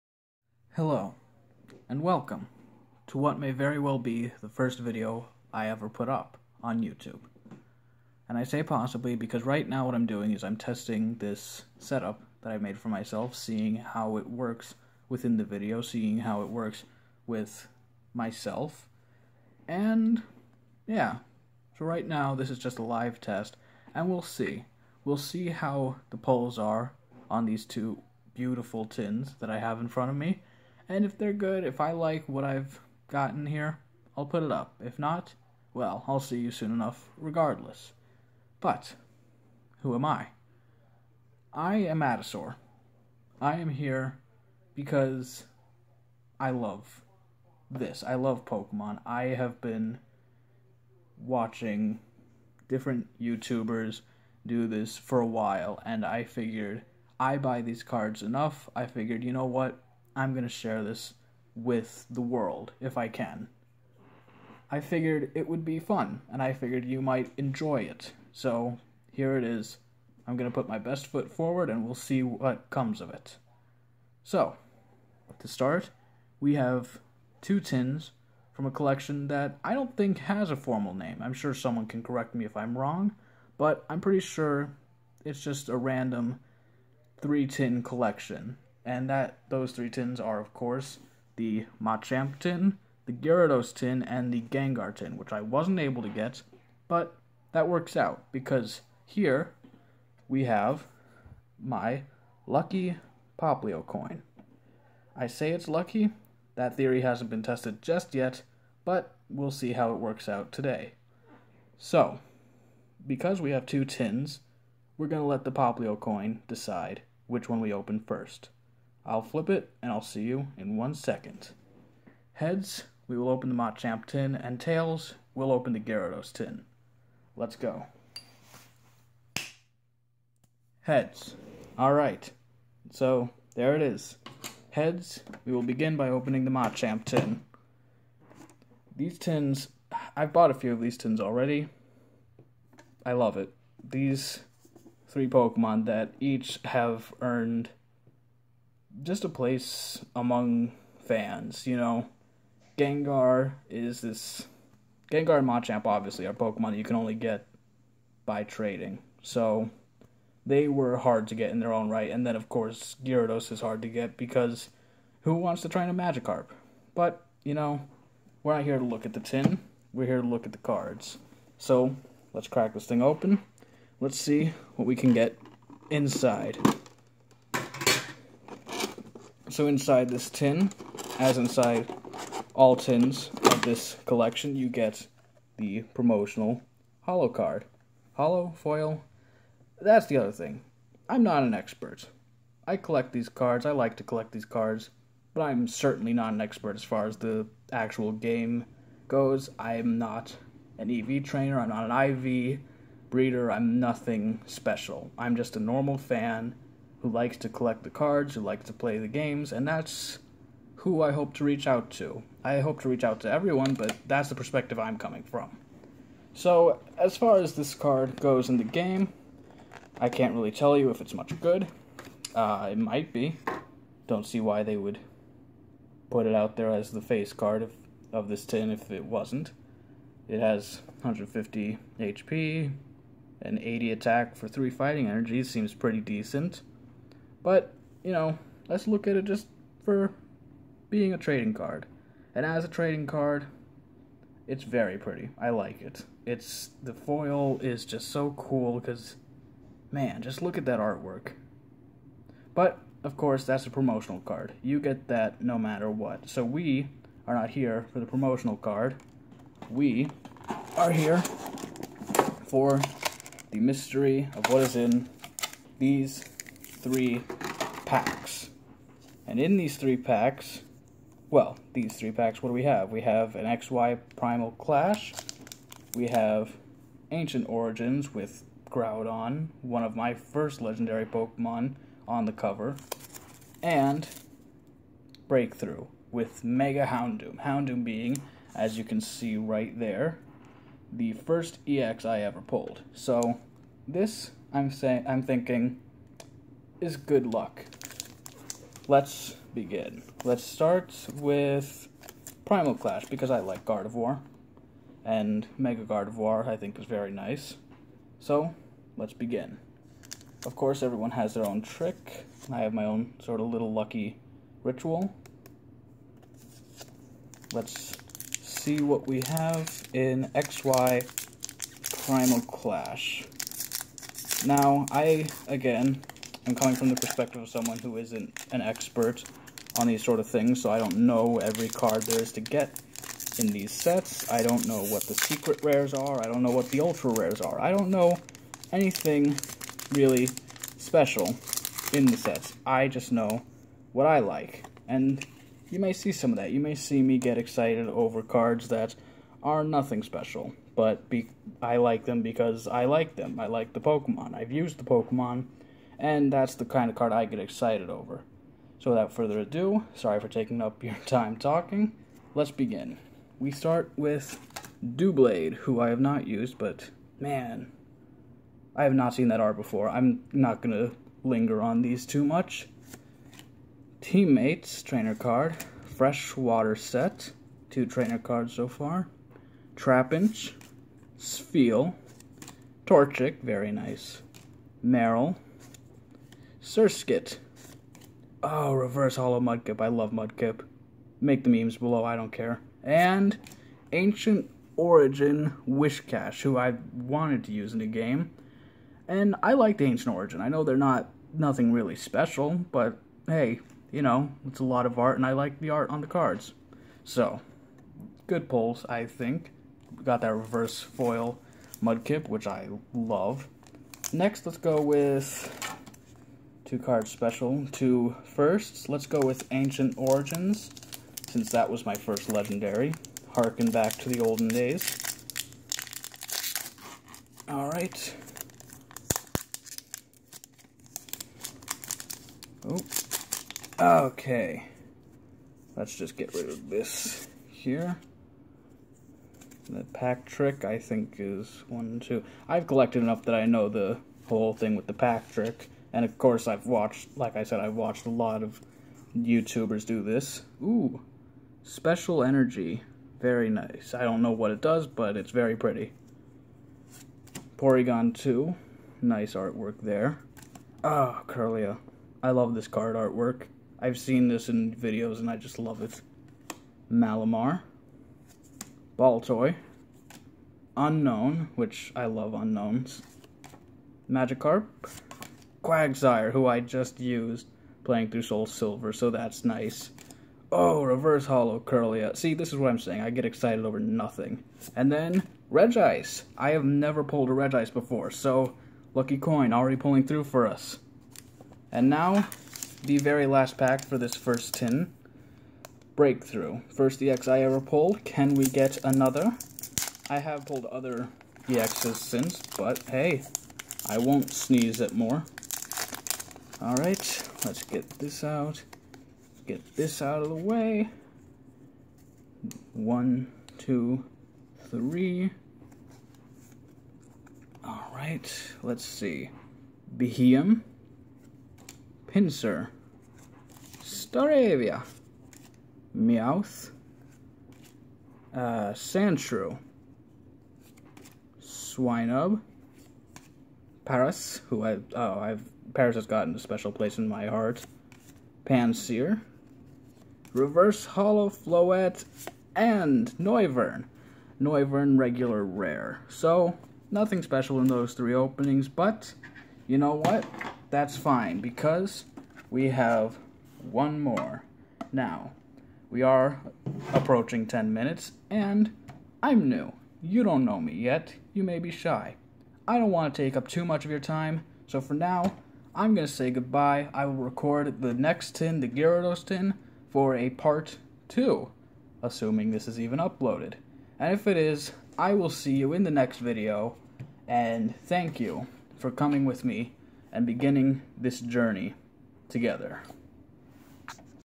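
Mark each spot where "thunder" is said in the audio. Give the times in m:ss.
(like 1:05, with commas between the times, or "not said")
not said.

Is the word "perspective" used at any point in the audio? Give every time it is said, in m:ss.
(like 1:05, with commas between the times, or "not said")
3:34, 5:26.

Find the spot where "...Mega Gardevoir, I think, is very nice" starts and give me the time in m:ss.
5:05.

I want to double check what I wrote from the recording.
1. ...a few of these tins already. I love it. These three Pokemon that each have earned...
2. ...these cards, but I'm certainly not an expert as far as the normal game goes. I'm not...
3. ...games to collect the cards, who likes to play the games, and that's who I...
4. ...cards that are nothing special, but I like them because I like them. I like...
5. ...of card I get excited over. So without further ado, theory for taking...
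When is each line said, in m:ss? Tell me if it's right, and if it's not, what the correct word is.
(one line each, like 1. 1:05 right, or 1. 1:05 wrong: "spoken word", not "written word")
1. 2:20 right
2. 3:14 wrong: "actual", not "normal"
3. 3:27 wrong: "likes", not "games"
4. 5:48 right
5. 5:56 wrong: "sorry", not "theory".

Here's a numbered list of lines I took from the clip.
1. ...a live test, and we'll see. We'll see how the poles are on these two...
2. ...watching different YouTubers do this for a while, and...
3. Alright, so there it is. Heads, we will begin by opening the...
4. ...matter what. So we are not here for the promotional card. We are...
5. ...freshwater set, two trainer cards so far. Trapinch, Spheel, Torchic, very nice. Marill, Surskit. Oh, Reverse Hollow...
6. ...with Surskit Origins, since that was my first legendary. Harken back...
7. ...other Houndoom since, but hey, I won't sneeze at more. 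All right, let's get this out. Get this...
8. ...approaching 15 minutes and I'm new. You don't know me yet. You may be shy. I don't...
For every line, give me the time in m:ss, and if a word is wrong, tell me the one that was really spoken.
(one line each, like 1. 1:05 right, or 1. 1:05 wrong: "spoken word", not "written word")
1. 0:22 right
2. 0:51 right
3. 2:11 right
4. 4:15 right
5. 6:15 right
6. 6:59 wrong: "Ancient", not "Surskit"
7. 8:20 wrong: "EXs", not "Houndoom"
8. 9:16 wrong: "10", not "15".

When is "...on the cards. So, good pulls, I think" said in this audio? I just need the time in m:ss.
6:45.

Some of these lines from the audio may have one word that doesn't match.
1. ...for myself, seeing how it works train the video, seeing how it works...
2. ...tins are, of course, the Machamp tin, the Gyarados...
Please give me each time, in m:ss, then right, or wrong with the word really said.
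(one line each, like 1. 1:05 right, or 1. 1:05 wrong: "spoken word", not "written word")
1. 0:12 wrong: "within", not "train"
2. 1:29 right.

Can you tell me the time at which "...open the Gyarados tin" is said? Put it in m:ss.
2:05.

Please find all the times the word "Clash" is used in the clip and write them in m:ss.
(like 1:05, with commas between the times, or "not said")
4:34, 5:02, 5:22.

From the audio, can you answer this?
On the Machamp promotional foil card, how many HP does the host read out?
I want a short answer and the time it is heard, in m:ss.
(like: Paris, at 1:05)
150, at 3:51.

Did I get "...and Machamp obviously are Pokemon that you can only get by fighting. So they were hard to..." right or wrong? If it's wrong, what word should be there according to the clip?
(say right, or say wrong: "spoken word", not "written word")
wrong: "trading", not "fighting".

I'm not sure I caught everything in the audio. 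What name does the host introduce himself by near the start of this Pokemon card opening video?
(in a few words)
Atasaur.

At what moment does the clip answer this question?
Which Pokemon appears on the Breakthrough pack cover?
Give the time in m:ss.
4:46.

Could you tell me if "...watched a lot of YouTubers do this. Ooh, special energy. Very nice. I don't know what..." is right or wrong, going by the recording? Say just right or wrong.
right.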